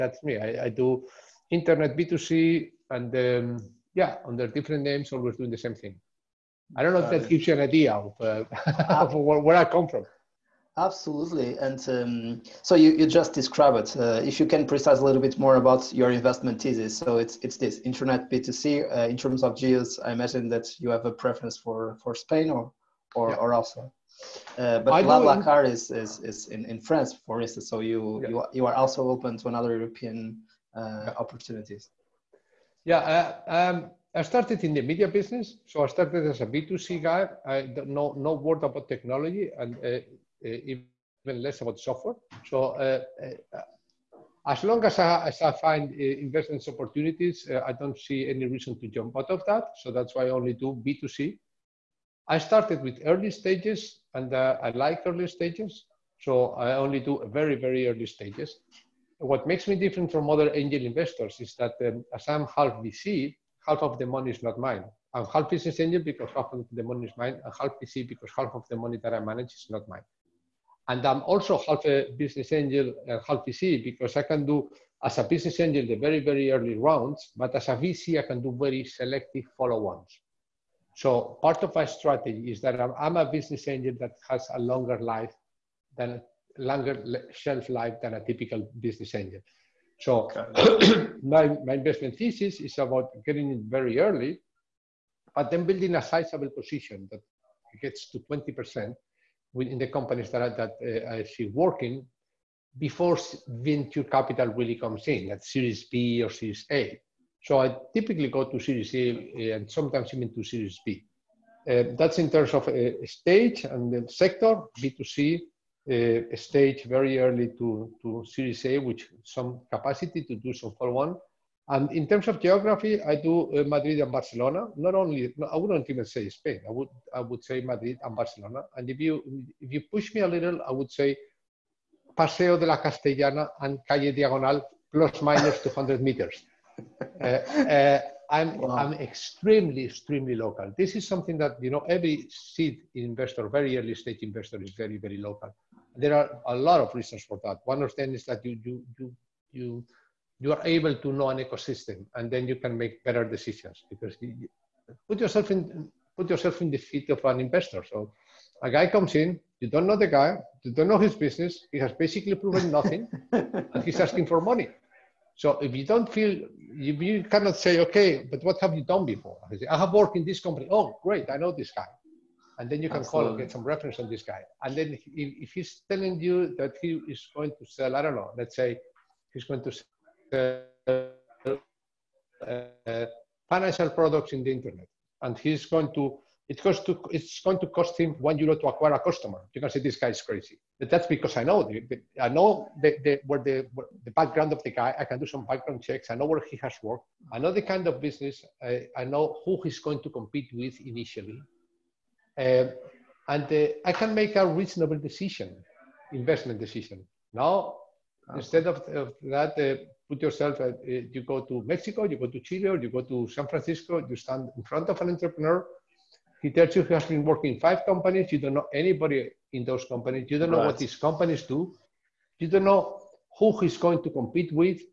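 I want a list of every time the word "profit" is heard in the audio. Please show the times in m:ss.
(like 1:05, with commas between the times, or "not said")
not said.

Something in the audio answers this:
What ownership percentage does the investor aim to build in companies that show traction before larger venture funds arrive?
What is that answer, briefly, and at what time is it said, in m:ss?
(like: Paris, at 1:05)
20%, at 1:38.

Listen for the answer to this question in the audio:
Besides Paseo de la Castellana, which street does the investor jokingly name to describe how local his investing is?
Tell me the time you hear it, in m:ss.
2:13.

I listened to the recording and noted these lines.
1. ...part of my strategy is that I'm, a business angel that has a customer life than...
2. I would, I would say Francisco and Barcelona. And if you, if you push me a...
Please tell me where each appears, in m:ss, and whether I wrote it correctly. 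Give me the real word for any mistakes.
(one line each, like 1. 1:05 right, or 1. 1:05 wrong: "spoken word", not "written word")
1. 1:21 wrong: "longer", not "customer"
2. 2:06 wrong: "Madrid", not "Francisco".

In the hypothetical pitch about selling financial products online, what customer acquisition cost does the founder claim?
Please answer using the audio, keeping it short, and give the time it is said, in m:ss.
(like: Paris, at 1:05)
1 euro, at 3:08.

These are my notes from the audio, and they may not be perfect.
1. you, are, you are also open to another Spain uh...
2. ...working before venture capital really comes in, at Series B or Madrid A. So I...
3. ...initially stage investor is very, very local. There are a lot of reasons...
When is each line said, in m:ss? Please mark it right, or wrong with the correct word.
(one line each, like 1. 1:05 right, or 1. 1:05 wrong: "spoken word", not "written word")
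1. 0:28 wrong: "European", not "Spain"
2. 1:41 wrong: "Series", not "Madrid"
3. 2:23 wrong: "early", not "initially".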